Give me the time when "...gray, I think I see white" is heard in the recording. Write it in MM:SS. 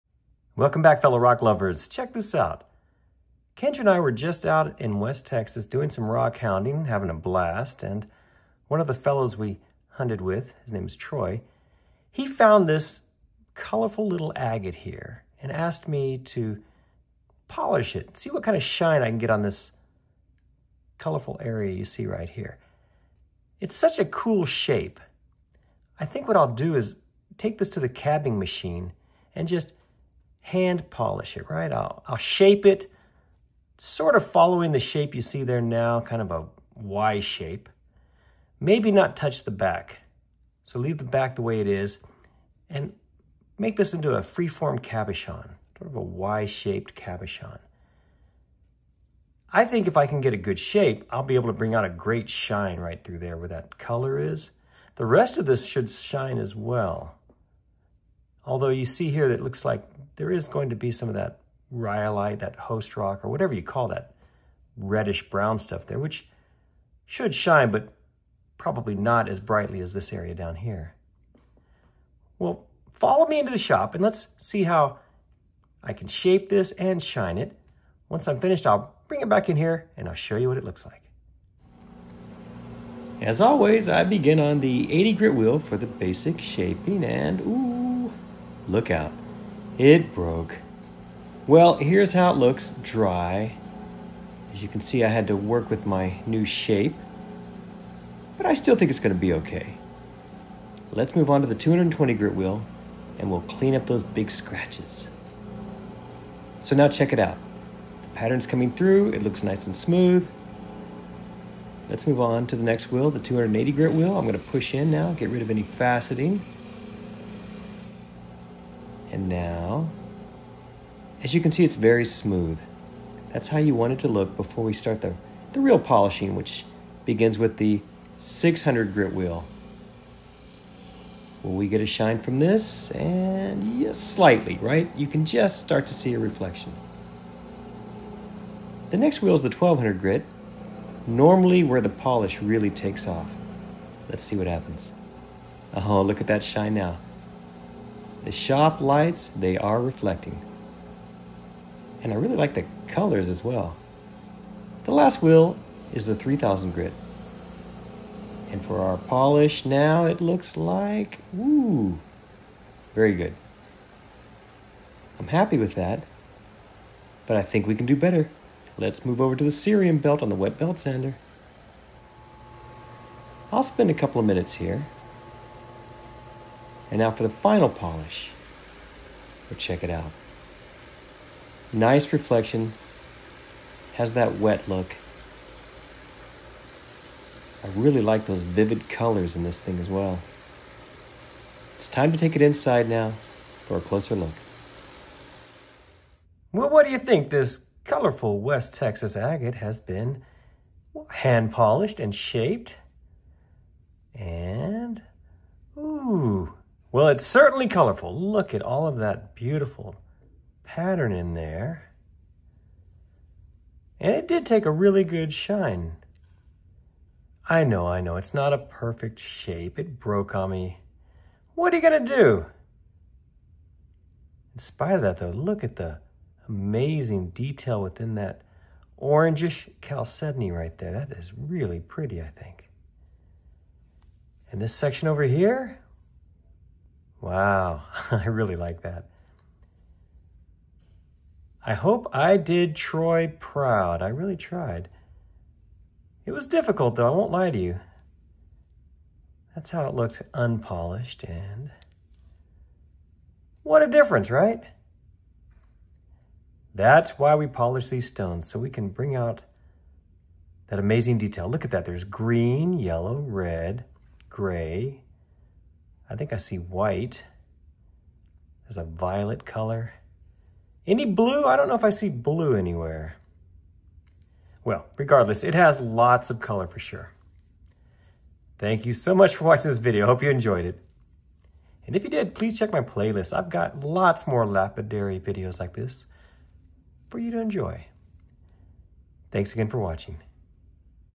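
04:24.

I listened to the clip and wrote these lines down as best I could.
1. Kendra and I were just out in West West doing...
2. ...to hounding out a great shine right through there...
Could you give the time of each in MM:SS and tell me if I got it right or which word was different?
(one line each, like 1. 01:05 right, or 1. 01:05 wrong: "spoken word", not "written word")
1. 00:03 wrong: "Texas", not "West"
2. 00:51 wrong: "bring", not "hounding".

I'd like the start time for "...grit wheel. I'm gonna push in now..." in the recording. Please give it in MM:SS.
01:53.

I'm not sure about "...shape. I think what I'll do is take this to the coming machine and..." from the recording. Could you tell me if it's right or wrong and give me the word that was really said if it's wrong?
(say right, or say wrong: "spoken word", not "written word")
wrong: "cabbing", not "coming".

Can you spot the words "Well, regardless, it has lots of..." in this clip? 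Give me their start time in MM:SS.
04:34.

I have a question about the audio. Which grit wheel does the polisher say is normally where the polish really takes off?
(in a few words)
1200 grit.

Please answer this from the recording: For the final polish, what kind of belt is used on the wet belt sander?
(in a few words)
cerium belt.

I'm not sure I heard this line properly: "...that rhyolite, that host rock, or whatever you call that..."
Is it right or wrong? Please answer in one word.
right.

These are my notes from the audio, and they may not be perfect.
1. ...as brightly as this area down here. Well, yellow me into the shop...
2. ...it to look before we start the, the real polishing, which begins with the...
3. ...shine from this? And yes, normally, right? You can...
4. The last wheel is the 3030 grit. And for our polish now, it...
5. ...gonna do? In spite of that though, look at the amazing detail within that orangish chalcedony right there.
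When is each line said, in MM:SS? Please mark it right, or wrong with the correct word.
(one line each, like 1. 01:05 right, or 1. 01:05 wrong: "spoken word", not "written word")
1. 01:09 wrong: "follow", not "yellow"
2. 02:03 right
3. 02:11 wrong: "slightly", not "normally"
4. 02:34 wrong: "3000", not "3030"
5. 03:41 right.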